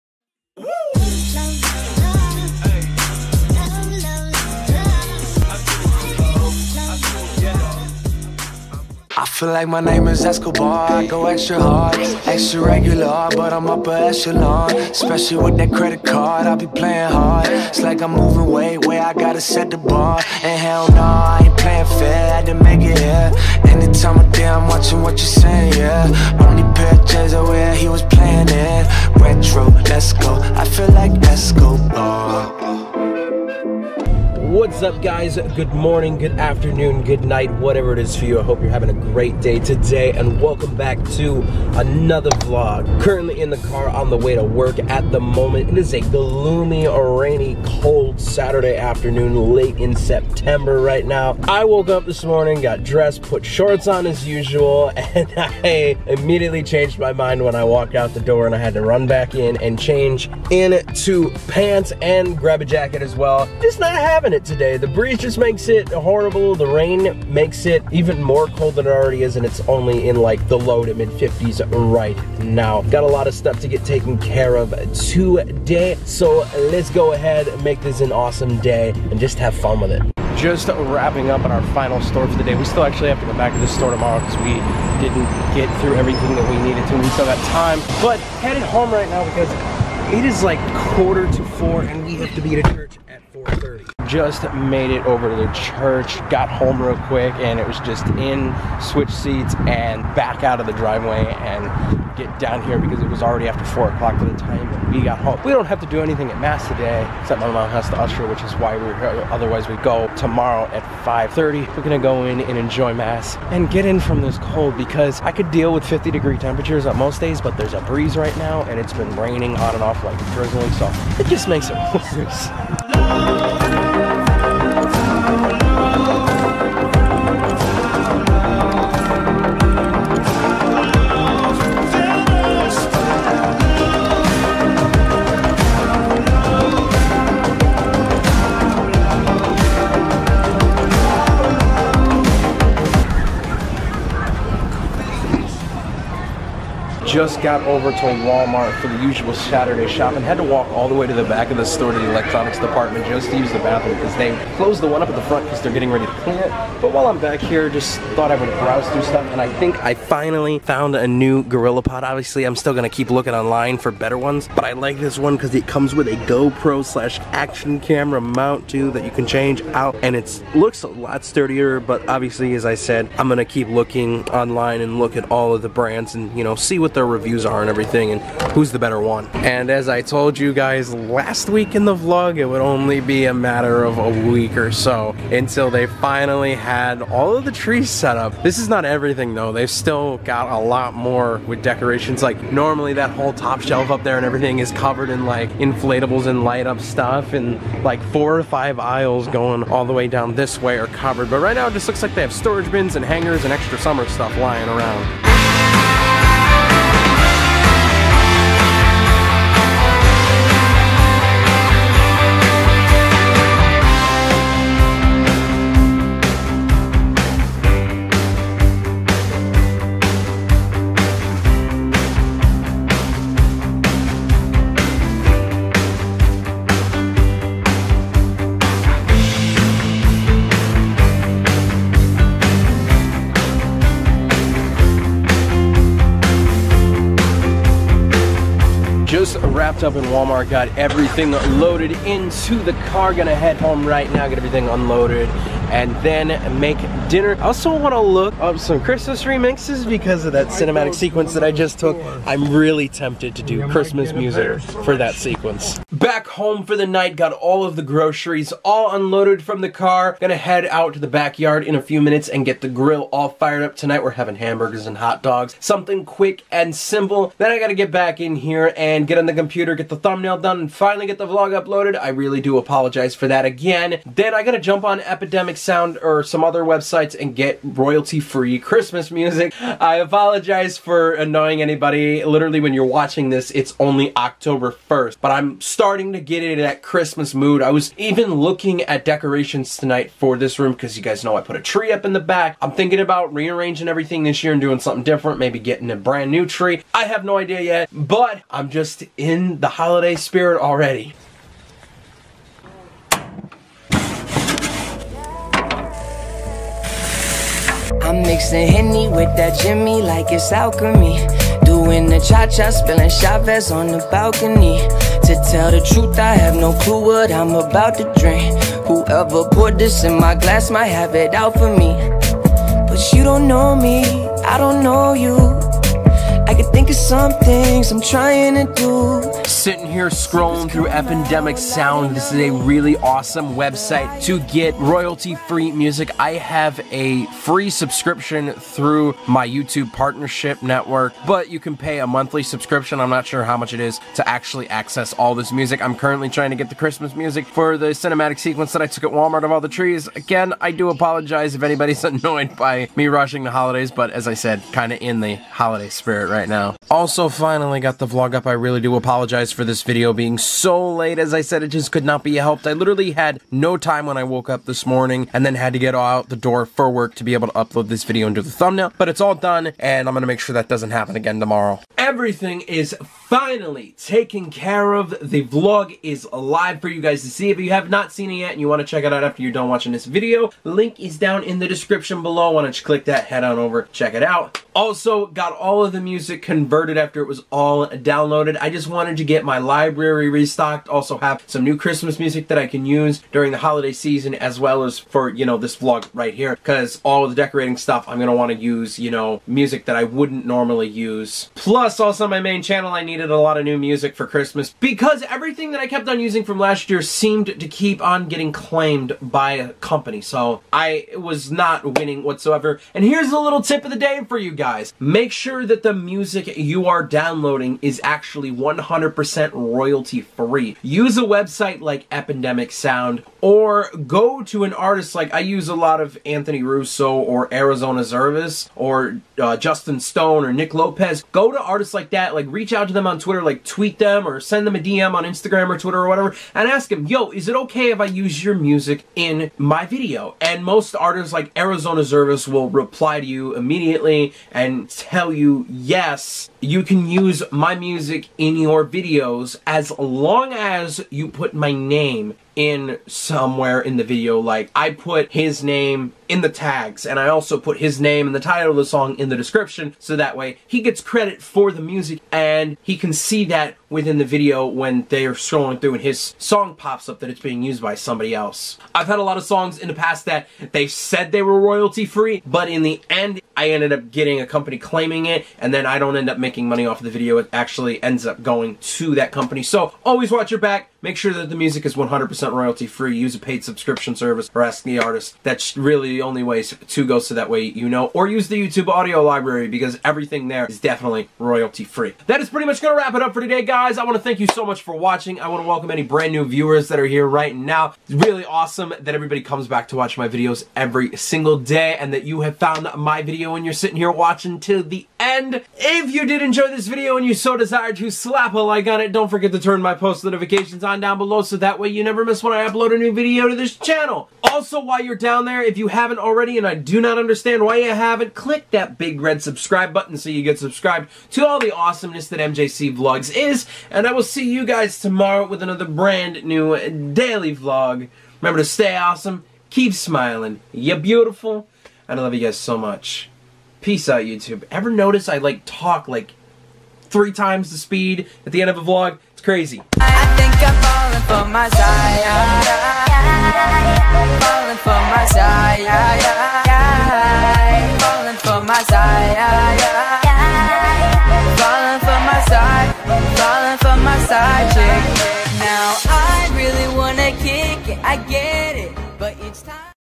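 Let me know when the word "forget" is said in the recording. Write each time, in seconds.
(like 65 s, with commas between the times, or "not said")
509 s.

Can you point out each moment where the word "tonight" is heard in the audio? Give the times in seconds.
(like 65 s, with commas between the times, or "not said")
263 s, 289 s.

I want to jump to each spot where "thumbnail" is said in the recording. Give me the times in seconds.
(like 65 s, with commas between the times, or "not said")
269 s, 368 s.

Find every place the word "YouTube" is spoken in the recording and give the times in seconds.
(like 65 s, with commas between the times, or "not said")
339 s, 488 s, 534 s.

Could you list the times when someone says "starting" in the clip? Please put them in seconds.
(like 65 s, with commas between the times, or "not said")
285 s.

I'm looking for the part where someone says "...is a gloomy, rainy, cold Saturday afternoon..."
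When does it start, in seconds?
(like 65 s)
45 s.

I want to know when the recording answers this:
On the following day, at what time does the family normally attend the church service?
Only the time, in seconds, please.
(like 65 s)
111 s.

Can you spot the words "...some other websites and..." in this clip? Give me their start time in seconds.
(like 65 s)
276 s.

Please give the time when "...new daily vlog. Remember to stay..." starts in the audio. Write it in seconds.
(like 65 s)
526 s.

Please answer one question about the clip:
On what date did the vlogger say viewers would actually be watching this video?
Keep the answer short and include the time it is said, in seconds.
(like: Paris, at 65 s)
October 1st, at 284 s.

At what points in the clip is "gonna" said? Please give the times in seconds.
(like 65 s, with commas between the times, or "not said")
162 s, 173 s, 243 s, 260 s.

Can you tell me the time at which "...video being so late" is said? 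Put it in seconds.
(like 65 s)
359 s.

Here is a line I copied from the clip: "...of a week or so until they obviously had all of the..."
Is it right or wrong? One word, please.
wrong.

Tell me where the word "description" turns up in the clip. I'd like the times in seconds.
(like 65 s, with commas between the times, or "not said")
381 s, 459 s.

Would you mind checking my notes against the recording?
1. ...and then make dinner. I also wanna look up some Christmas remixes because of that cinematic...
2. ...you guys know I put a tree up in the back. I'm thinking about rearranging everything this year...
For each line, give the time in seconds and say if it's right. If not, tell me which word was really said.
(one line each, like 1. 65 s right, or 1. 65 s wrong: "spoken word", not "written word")
1. 245 s right
2. 290 s right.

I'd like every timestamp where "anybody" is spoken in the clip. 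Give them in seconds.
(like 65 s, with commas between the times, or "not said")
281 s, 351 s.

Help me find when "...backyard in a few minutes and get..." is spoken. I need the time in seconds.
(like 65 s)
261 s.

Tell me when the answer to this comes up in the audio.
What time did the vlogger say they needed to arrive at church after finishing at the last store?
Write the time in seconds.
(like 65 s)
93 s.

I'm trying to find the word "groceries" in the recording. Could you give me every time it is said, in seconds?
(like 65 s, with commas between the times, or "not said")
257 s.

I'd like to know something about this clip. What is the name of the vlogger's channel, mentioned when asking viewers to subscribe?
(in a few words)
MJC Vlogs.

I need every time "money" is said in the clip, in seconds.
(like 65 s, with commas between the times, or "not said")
476 s.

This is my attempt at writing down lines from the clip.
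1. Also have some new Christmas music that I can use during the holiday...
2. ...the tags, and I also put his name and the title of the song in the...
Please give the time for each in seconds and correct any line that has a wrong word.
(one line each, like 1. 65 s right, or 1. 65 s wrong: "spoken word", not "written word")
1. 390 s right
2. 456 s right.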